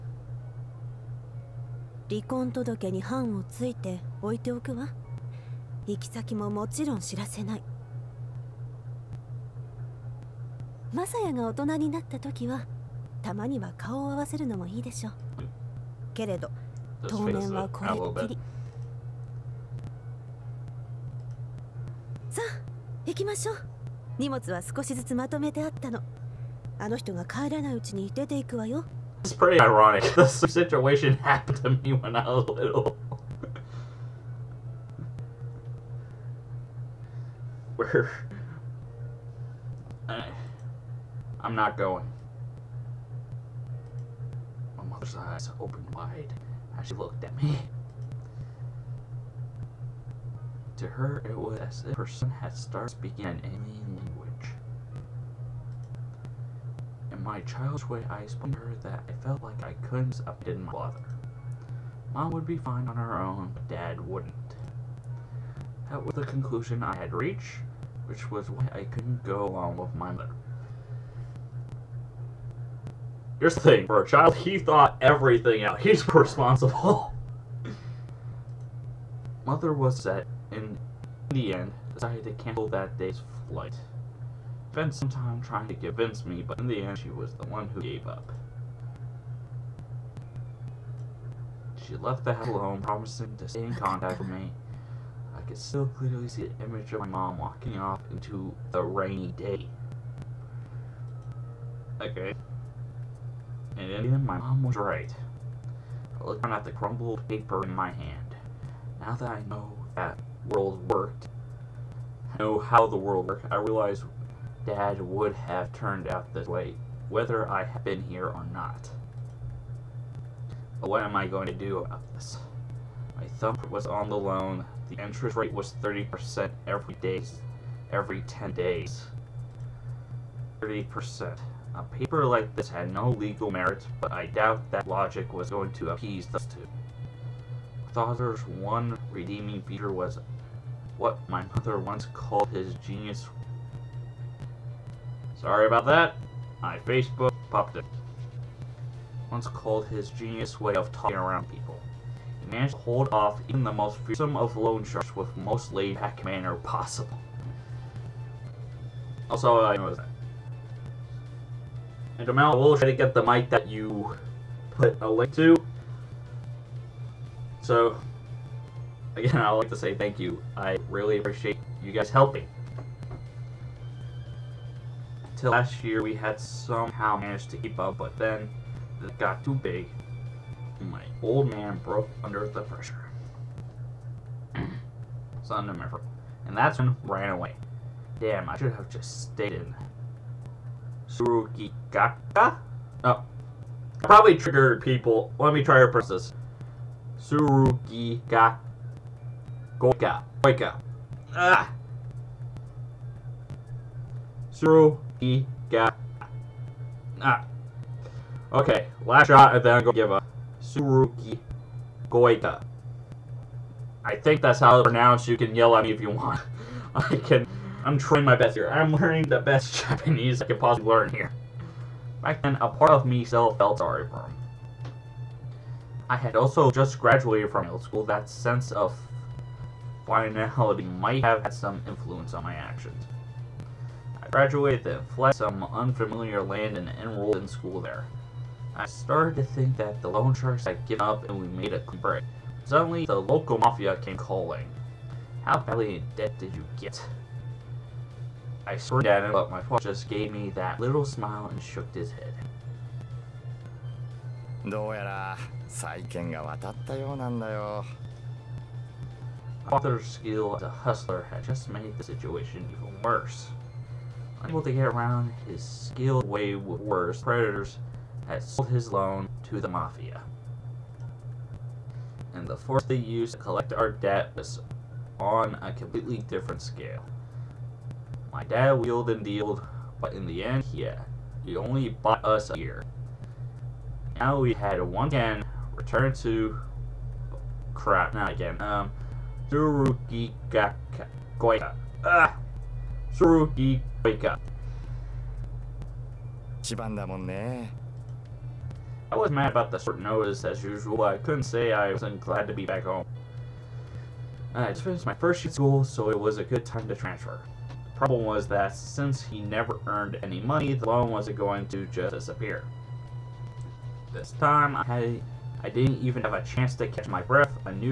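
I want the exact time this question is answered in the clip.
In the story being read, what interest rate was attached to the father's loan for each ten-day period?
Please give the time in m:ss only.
2:05.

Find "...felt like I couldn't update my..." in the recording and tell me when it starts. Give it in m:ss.
0:59.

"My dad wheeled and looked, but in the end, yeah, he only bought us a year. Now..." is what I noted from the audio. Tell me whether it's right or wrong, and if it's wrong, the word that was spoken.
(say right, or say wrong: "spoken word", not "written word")
wrong: "dealed", not "looked".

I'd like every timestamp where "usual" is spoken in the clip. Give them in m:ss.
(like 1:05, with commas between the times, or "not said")
5:00.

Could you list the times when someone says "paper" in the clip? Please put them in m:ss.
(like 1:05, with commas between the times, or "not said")
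1:47, 2:11.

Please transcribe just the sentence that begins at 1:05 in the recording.
That was the conclusion I had reached, which was why I couldn't go along with my mother.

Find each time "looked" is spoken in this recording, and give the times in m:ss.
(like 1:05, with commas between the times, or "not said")
0:46, 1:46.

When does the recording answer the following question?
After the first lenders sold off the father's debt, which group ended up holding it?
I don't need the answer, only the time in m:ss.
4:29.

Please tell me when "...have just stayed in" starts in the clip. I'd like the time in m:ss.
3:08.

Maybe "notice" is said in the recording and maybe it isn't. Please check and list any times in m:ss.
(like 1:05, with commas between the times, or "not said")
4:59.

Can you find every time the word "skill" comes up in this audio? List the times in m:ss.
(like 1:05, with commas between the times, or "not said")
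4:20, 4:25.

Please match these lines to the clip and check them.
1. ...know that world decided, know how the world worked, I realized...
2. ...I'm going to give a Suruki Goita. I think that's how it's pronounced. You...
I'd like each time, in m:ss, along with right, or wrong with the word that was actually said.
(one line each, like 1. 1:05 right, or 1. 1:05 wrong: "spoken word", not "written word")
1. 1:49 wrong: "worked", not "decided"
2. 3:29 right.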